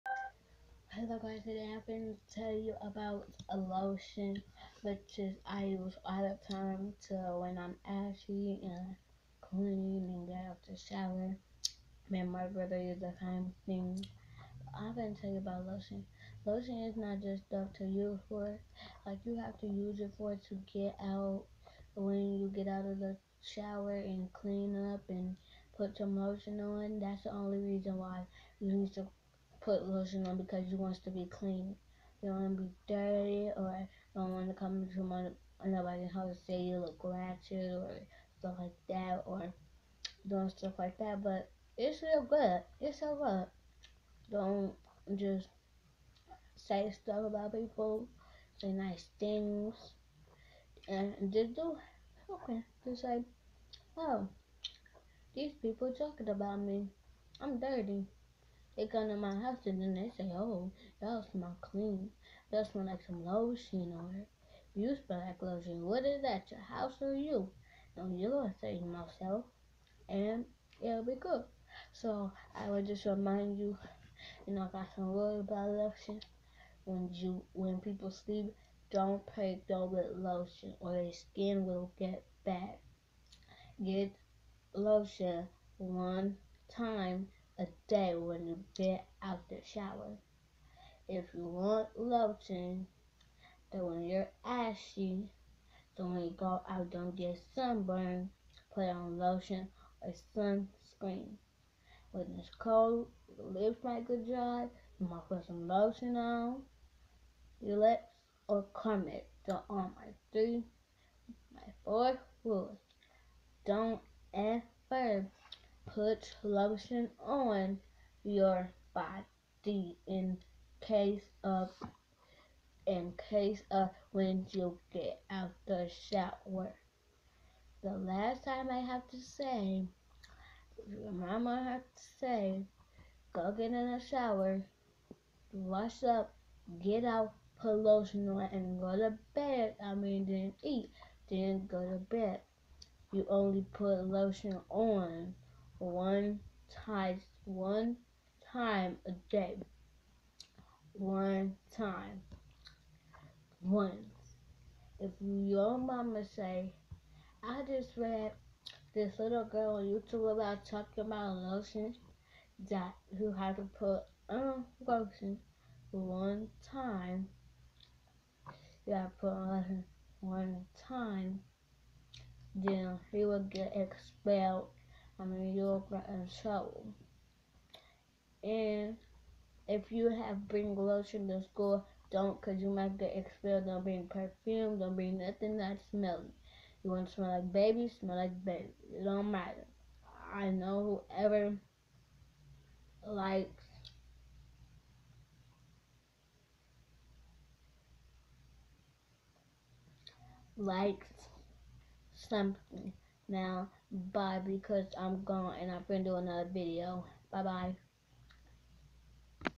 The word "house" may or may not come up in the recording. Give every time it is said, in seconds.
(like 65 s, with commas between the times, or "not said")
36 s, 59 s, 66 s.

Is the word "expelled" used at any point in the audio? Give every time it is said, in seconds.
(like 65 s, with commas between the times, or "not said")
173 s, 183 s.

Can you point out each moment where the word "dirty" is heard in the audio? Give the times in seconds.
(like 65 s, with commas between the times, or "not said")
32 s, 57 s.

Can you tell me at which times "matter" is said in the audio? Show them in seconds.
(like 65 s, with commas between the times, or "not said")
189 s.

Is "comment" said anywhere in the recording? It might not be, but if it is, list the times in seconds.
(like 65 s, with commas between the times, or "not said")
108 s.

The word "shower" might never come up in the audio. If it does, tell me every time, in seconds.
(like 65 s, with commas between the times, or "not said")
10 s, 23 s, 89 s, 125 s, 133 s.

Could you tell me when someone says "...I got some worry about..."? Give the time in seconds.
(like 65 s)
74 s.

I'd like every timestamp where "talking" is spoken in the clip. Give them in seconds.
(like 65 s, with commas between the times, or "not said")
55 s, 160 s.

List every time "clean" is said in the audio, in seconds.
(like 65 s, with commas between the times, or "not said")
9 s, 24 s, 31 s, 61 s.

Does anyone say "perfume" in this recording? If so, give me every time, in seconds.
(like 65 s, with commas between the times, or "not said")
184 s.